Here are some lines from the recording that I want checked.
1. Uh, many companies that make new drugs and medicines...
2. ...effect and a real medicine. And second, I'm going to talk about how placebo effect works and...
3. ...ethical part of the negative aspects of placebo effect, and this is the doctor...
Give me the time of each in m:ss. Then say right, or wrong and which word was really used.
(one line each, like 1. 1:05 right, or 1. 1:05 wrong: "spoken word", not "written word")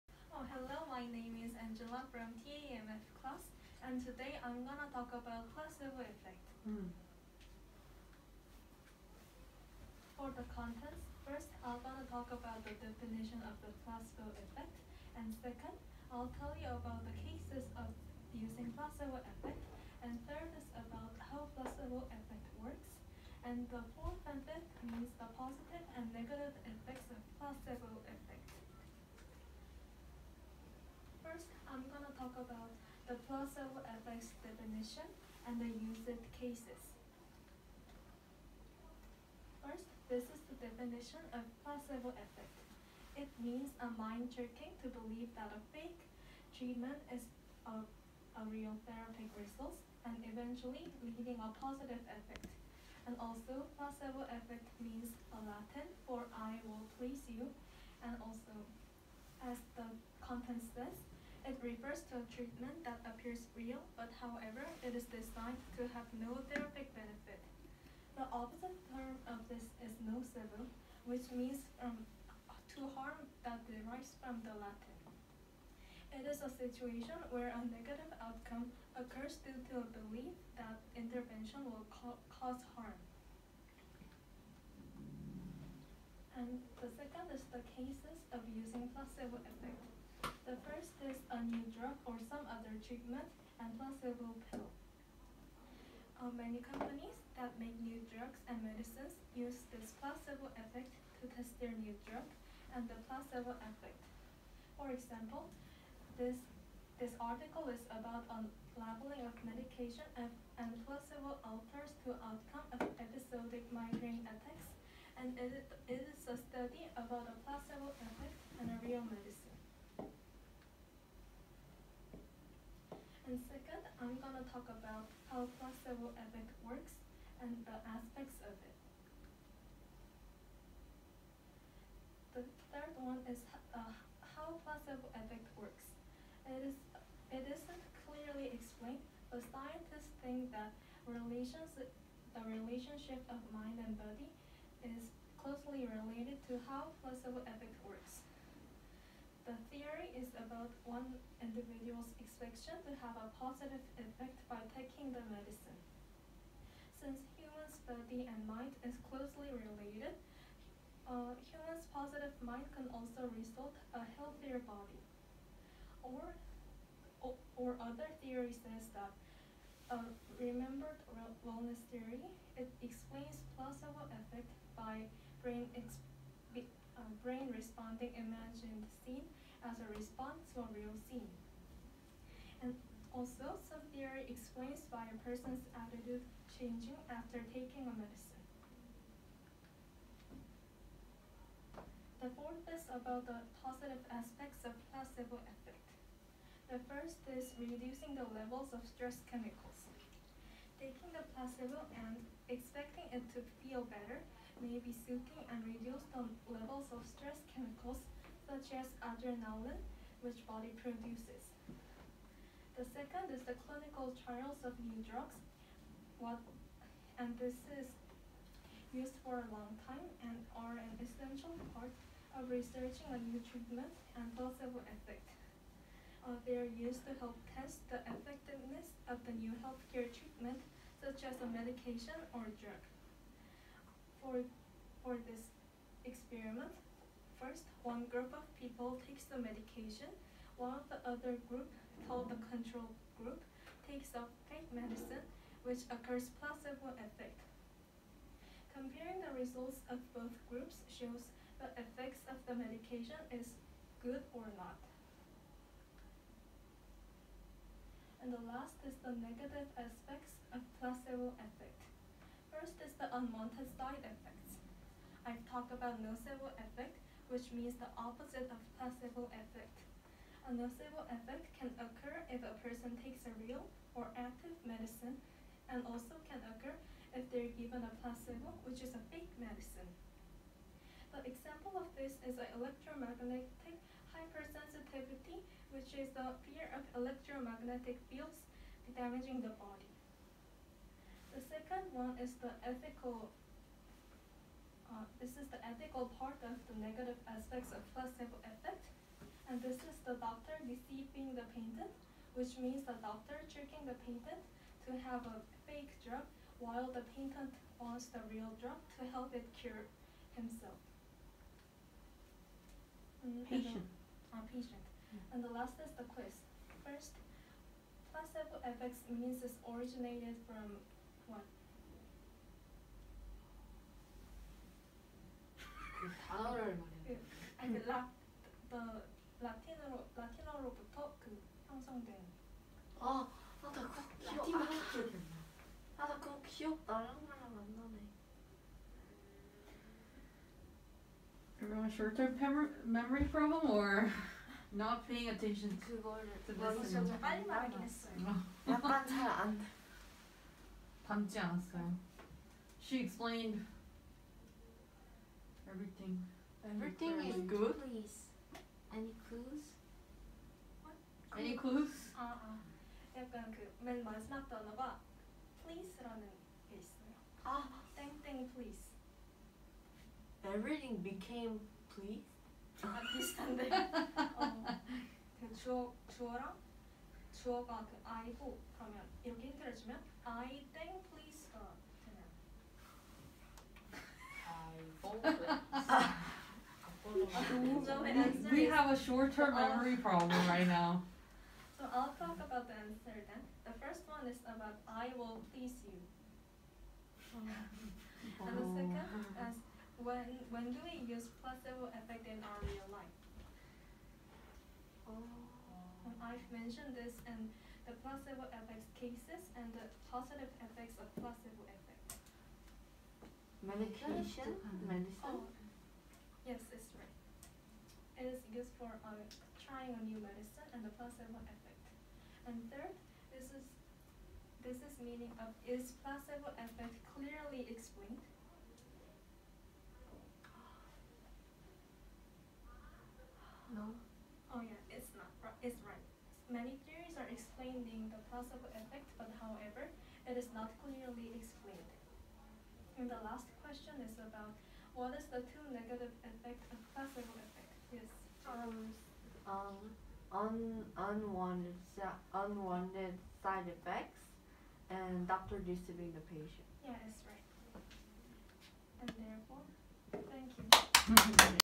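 1. 1:36 right
2. 1:58 right
3. 4:55 right.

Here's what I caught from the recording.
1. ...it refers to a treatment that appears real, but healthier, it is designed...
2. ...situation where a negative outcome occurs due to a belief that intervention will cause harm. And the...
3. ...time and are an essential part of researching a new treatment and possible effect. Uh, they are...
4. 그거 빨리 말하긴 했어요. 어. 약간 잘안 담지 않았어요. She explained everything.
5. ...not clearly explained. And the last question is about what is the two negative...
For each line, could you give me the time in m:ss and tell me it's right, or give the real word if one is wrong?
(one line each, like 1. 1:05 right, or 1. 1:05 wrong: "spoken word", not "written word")
1. 1:01 wrong: "however", not "healthier"
2. 1:16 right
3. 3:39 right
4. 5:46 right
5. 7:20 right.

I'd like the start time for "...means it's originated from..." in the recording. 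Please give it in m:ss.
5:19.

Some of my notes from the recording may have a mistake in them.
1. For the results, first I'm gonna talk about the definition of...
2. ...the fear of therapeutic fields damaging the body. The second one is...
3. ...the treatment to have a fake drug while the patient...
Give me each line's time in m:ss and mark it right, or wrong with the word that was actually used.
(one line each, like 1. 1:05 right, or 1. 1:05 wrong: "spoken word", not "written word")
1. 0:10 wrong: "contents", not "results"
2. 4:46 wrong: "electromagnetic", not "therapeutic"
3. 5:03 wrong: "patient", not "treatment".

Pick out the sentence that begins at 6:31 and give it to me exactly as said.
so I'll talk about the answer then.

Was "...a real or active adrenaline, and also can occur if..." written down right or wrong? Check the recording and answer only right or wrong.
wrong.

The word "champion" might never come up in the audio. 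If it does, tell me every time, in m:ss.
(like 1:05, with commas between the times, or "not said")
not said.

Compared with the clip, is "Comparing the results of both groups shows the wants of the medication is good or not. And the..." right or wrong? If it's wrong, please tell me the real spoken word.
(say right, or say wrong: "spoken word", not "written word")
wrong: "effects", not "wants".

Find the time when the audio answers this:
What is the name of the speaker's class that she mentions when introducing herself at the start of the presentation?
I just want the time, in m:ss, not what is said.
0:02.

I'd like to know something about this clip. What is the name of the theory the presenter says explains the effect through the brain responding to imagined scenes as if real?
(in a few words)
remembered wellness theory.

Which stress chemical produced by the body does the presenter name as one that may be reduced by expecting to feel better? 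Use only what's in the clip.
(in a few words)
adrenaline.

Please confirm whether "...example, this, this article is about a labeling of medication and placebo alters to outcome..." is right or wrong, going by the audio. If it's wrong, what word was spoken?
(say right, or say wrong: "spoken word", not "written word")
right.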